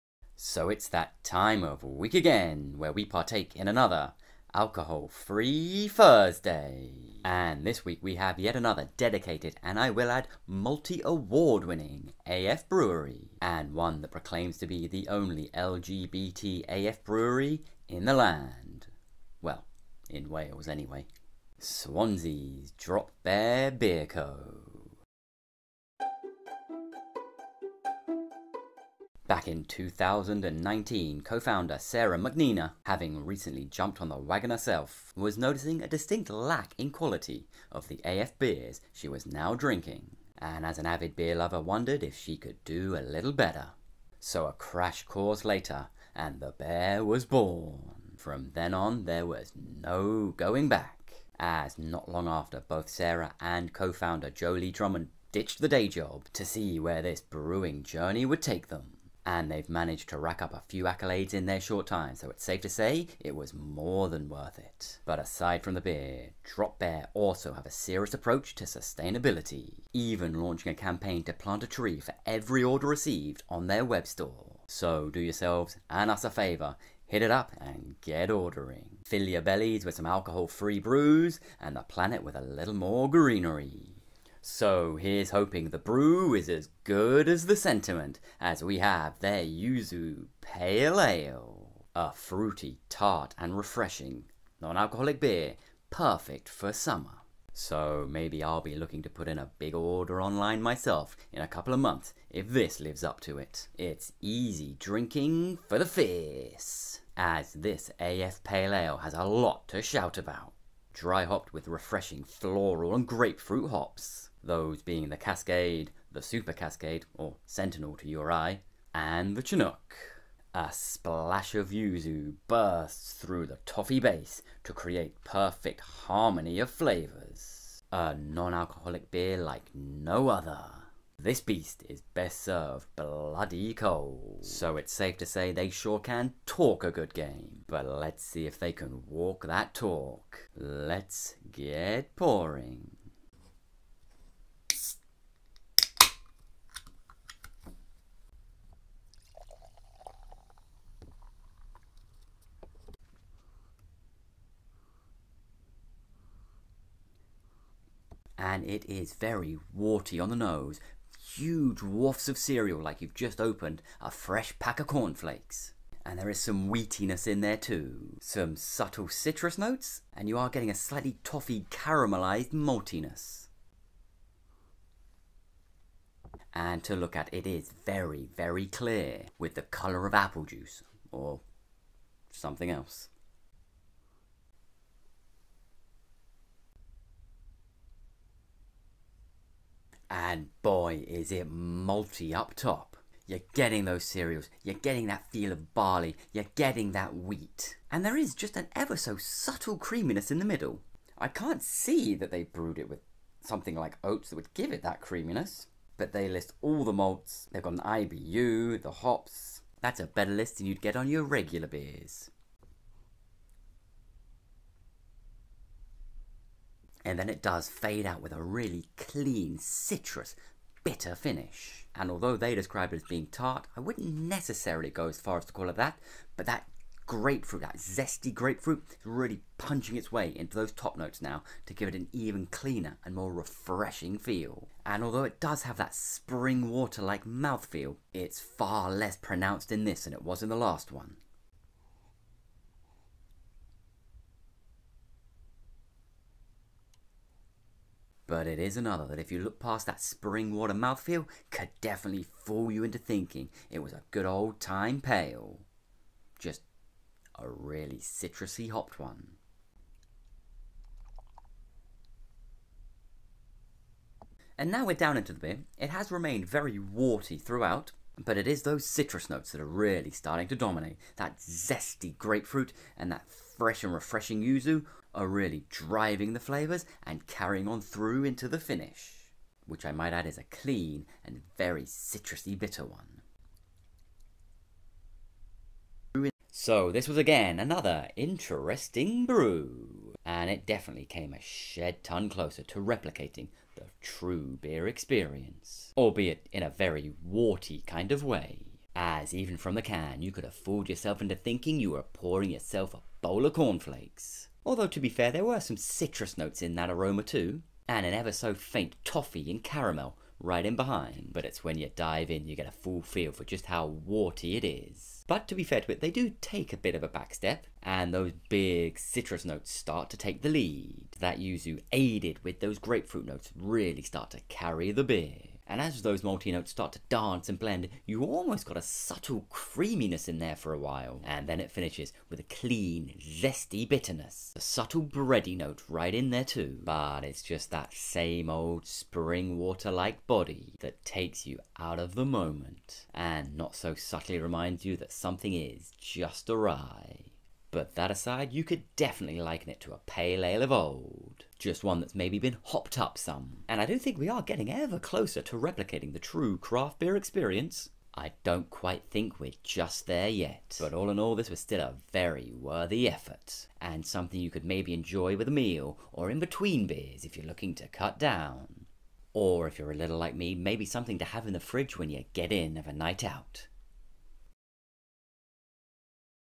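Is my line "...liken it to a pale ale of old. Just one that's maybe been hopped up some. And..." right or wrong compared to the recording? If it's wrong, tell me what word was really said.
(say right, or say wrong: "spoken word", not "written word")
right.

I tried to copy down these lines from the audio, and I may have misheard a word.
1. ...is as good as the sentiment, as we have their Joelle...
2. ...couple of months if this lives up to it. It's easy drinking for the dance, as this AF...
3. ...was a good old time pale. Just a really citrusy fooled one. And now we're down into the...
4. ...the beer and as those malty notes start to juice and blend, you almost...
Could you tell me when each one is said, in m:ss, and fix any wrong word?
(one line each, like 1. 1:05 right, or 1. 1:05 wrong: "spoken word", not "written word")
1. 1:26 wrong: "Yuzu", not "Joelle"
2. 1:41 wrong: "fierce", not "dance"
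3. 4:13 wrong: "hopped", not "fooled"
4. 5:24 wrong: "dance", not "juice".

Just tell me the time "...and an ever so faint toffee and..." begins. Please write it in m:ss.
5:07.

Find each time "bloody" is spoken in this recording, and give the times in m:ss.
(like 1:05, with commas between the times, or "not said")
2:12.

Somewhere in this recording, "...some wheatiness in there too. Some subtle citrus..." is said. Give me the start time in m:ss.
2:46.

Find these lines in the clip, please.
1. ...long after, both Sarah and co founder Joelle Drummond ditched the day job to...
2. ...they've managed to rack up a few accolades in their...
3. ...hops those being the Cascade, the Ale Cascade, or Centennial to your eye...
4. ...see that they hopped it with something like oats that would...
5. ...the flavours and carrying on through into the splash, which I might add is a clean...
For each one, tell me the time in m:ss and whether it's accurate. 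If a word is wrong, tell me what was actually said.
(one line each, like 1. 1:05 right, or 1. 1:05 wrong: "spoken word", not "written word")
1. 0:52 right
2. 0:59 right
3. 1:53 wrong: "Super", not "Ale"
4. 3:21 wrong: "brewed", not "hopped"
5. 4:36 wrong: "finish", not "splash".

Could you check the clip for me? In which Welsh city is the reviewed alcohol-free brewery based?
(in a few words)
Swansea.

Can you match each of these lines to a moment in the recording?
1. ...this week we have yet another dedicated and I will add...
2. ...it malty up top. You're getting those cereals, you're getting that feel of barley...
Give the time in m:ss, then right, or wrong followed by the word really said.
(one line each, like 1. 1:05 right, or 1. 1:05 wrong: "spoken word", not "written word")
1. 0:07 right
2. 3:11 right.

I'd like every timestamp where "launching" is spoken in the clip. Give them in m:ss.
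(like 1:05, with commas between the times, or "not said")
1:10.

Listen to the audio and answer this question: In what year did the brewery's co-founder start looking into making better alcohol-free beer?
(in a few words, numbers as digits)
2019.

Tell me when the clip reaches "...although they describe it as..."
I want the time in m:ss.
3:42.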